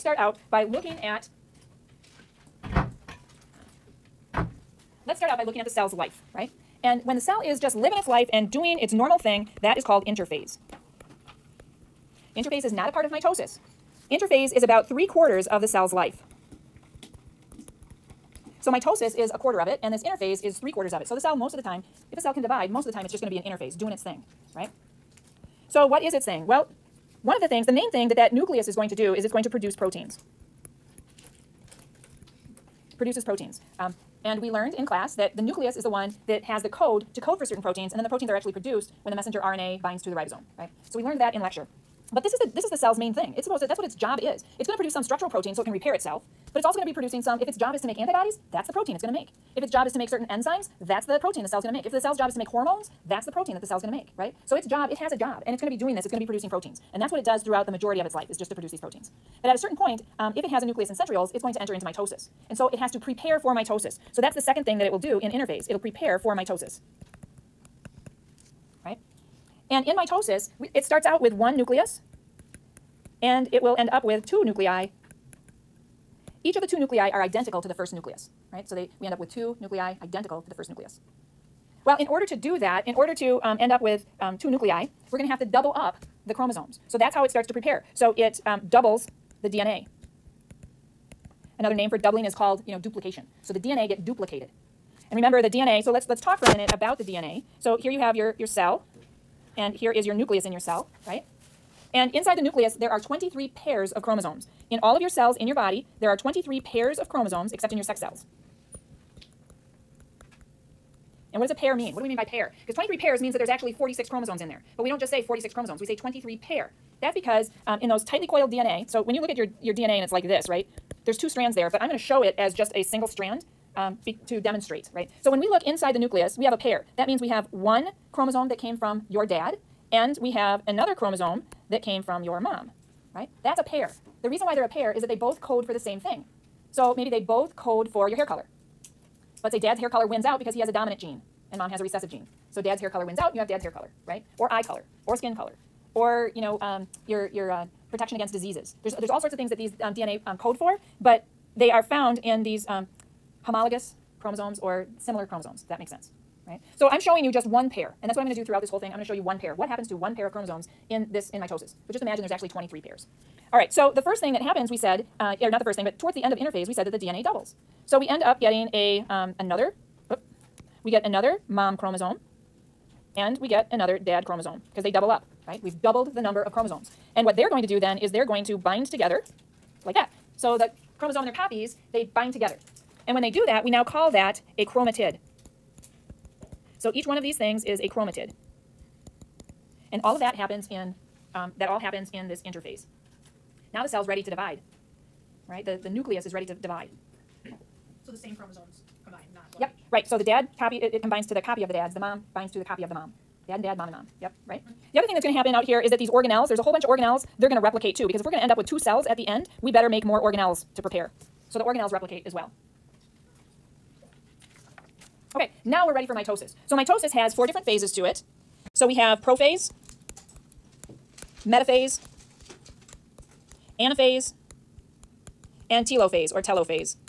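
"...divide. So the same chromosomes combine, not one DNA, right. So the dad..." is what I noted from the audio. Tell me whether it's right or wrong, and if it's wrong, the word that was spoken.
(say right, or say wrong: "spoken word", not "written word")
wrong: "Yep", not "DNA".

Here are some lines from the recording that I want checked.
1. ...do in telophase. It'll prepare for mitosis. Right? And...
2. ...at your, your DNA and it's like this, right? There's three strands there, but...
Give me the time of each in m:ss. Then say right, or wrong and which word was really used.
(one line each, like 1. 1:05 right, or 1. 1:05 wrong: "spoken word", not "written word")
1. 1:04 wrong: "interphase", not "telophase"
2. 1:59 wrong: "two", not "three".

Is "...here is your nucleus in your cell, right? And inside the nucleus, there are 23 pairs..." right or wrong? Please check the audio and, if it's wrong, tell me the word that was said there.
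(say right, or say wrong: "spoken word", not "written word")
right.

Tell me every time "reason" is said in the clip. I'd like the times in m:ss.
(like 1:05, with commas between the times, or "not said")
2:14.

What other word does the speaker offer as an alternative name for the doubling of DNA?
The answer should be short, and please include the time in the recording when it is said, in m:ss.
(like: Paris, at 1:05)
duplication, at 1:32.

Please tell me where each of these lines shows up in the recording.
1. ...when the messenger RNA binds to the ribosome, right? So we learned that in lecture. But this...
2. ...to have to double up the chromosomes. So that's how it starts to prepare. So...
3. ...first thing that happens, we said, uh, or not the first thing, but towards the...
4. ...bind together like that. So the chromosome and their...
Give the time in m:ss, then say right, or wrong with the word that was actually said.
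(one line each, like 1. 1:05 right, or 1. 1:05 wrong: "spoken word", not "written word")
1. 0:39 right
2. 1:25 right
3. 2:44 right
4. 2:58 right.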